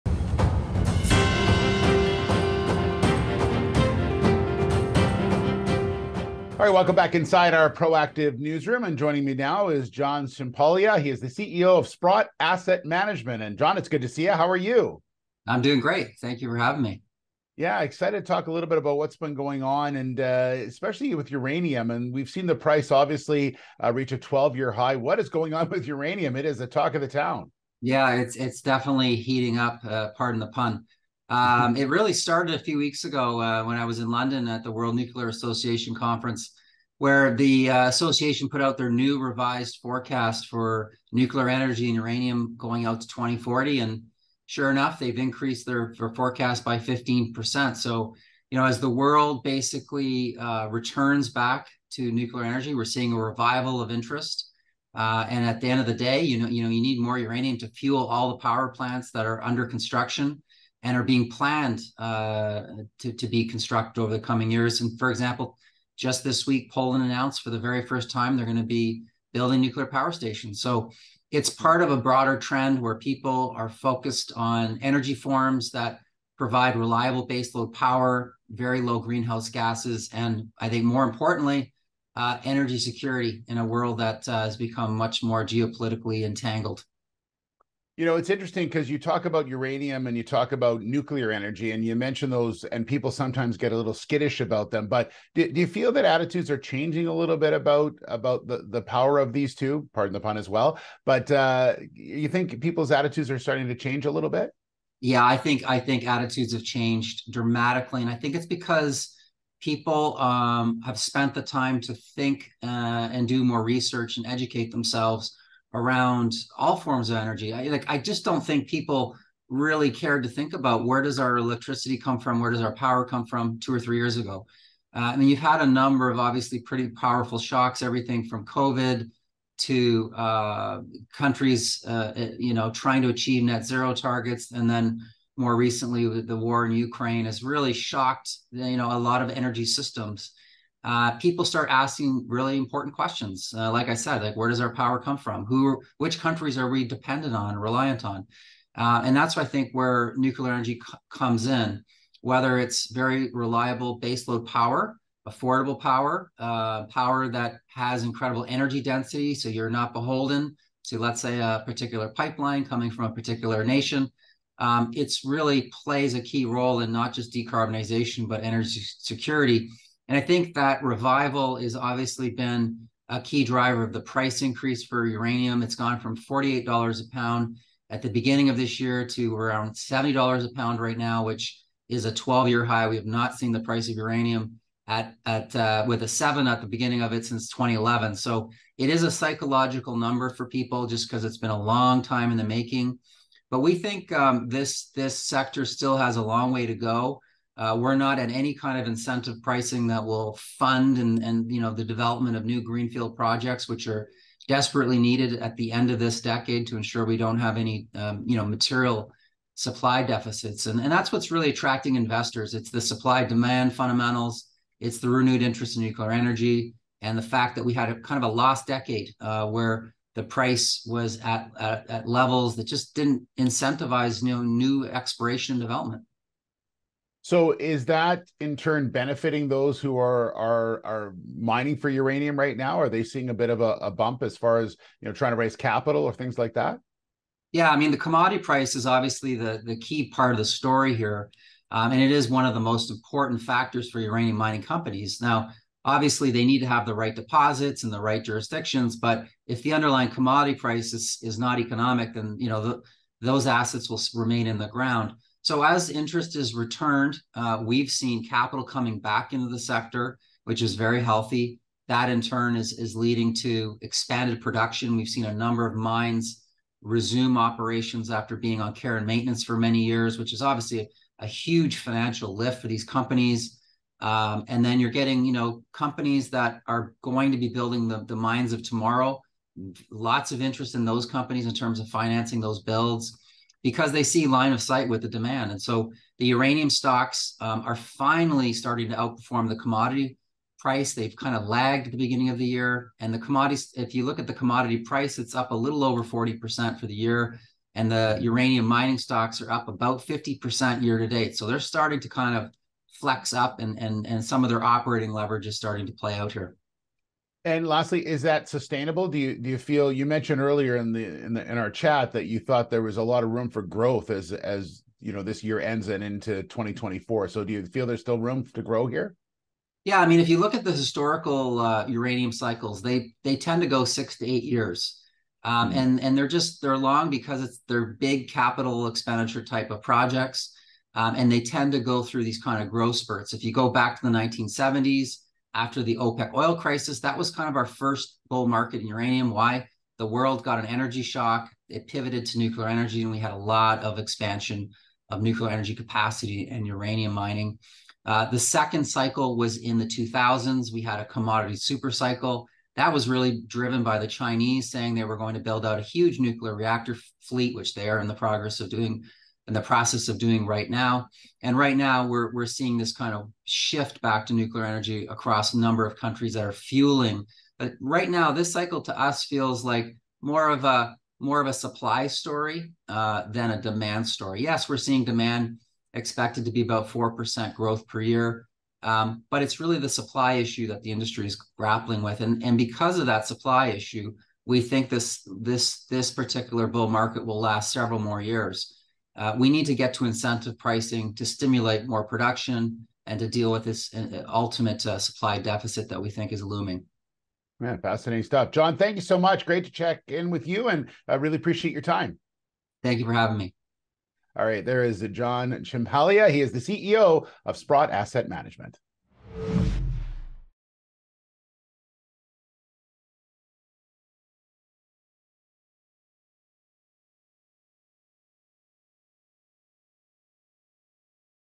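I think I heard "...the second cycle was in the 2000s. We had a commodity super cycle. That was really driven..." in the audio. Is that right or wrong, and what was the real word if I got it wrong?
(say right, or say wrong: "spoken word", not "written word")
right.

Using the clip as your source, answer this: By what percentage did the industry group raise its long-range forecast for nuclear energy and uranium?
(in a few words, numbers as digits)
15%.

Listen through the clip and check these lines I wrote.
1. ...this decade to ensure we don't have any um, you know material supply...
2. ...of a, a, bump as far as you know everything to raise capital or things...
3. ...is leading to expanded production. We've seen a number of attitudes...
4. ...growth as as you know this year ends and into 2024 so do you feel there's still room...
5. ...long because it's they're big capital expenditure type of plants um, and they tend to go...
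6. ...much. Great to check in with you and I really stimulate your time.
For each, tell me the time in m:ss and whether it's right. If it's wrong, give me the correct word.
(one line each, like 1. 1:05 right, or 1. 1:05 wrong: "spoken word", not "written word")
1. 3:25 right
2. 3:53 wrong: "trying", not "everything"
3. 4:22 wrong: "mines", not "attitudes"
4. 5:13 right
5. 5:26 wrong: "projects", not "plants"
6. 6:39 wrong: "appreciate", not "stimulate".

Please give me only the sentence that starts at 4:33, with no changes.
Um, and then you're getting, you know, companies that are going to be building the, the mines of tomorrow.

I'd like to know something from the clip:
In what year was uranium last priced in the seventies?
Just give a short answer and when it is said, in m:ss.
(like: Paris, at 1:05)
2011, at 3:07.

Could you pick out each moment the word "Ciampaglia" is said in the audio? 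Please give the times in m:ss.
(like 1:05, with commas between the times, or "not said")
0:10, 6:45.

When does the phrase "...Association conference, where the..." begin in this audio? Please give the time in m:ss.
0:35.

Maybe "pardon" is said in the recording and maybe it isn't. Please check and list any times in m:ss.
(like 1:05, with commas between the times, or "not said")
0:30, 1:39.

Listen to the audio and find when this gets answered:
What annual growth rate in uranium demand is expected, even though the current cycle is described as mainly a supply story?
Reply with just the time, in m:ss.
6:16.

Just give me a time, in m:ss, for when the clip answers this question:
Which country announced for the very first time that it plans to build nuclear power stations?
1:06.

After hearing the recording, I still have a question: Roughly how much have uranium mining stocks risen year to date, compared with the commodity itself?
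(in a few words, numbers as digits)
50%.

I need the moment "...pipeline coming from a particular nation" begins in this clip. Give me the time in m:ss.
2:42.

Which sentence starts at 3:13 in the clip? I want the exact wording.
But we think um, this this sector still has a long way to go.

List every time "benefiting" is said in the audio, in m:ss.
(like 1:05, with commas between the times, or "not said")
3:48.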